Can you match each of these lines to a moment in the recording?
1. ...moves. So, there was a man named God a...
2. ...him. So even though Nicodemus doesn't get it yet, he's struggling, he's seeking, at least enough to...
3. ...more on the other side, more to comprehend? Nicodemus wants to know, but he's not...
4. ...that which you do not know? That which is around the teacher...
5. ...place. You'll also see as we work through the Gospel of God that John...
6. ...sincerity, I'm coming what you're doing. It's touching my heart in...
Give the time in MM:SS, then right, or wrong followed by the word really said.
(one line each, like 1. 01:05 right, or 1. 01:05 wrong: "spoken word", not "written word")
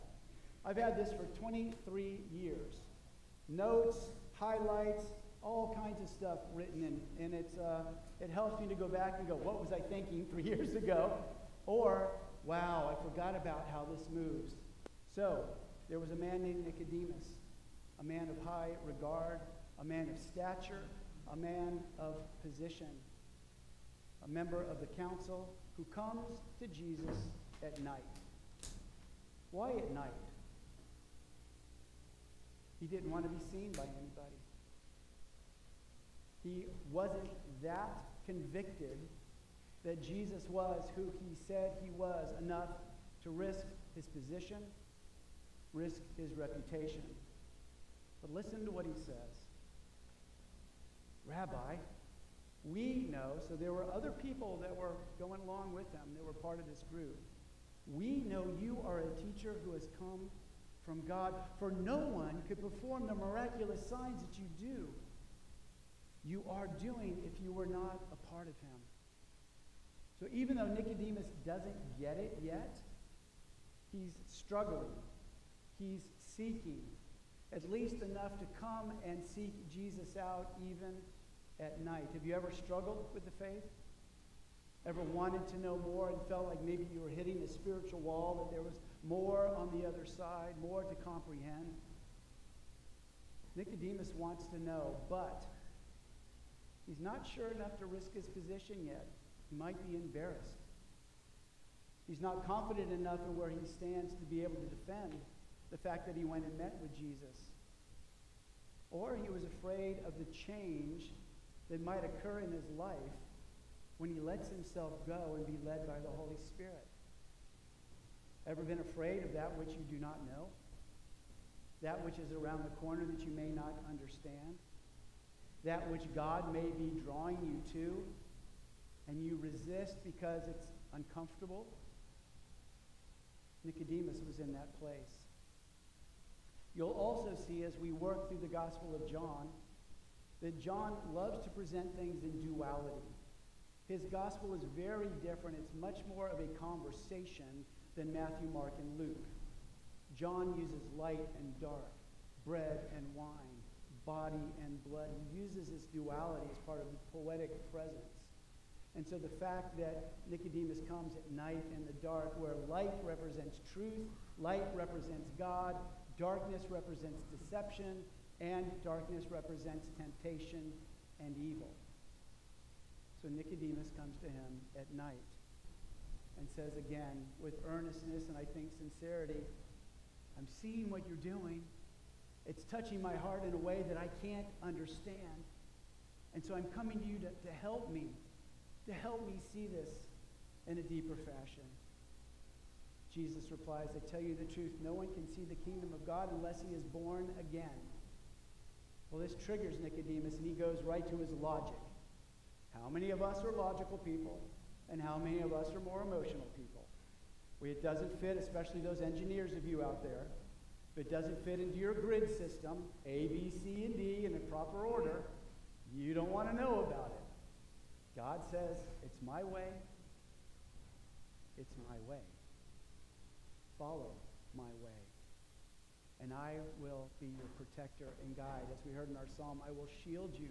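1. 00:14 wrong: "Nicodemus", not "God"
2. 01:08 right
3. 01:29 right
4. 01:59 wrong: "corner", not "teacher"
5. 02:14 wrong: "John", not "God"
6. 02:58 wrong: "seeing", not "coming".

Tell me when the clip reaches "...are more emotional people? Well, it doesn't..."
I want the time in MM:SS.
03:25.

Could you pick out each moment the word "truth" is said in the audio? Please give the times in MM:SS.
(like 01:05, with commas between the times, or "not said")
02:43, 03:14.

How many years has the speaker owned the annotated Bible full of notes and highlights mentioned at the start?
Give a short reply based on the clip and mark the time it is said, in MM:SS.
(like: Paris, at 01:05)
23, at 00:01.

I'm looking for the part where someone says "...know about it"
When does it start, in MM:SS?
03:36.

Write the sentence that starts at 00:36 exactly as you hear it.
He wasn't that convicted that Jesus was who he said he was enough to risk his position, risk his reputation.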